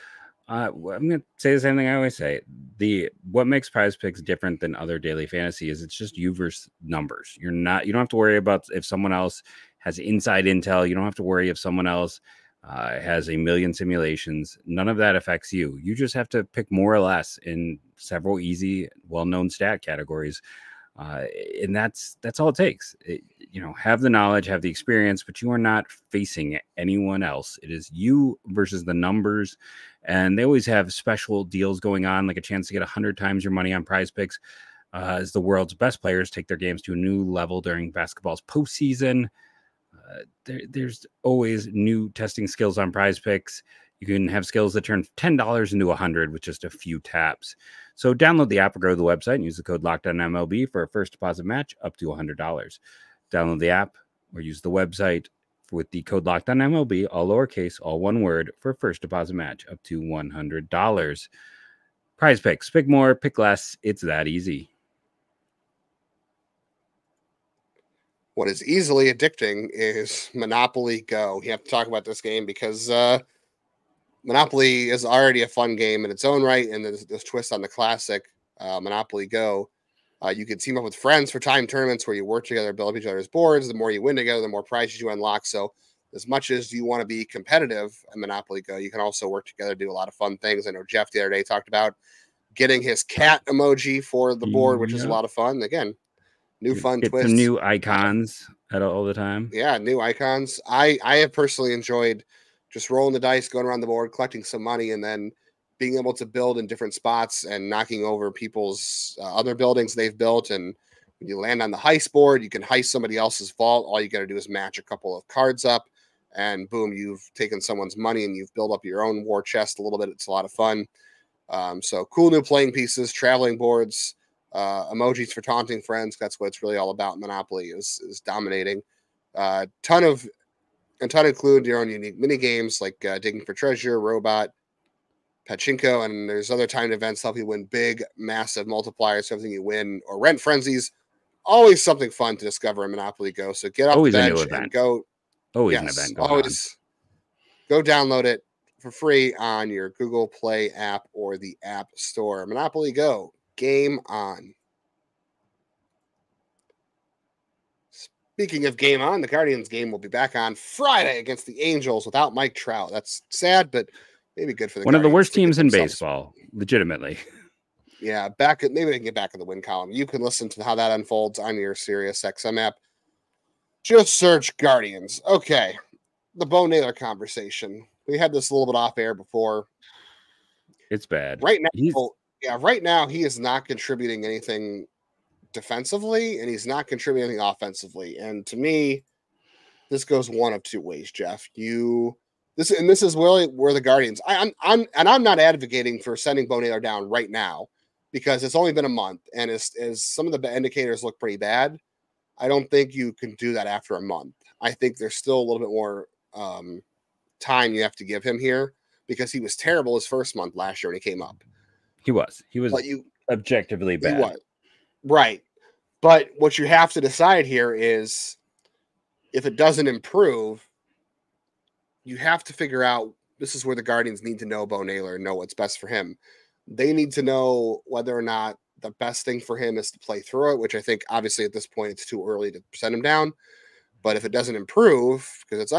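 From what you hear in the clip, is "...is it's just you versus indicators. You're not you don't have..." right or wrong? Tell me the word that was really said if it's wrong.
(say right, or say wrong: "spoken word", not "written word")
wrong: "numbers", not "indicators".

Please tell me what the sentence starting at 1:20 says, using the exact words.
Uh, you can team up with friends for time tournaments where you work together, build up each other's boards.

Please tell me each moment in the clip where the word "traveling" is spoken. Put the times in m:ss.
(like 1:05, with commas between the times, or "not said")
2:03.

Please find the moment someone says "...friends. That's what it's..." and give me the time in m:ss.
2:05.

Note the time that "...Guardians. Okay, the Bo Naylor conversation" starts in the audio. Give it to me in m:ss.
2:54.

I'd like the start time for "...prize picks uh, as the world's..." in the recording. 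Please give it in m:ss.
0:33.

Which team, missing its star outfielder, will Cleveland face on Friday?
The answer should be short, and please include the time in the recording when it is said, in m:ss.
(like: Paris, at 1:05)
Angels, at 2:41.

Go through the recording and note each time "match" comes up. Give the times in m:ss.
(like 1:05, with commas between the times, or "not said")
0:51, 0:59, 1:54.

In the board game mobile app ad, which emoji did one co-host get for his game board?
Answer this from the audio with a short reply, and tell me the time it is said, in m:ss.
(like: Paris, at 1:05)
cat emoji, at 1:33.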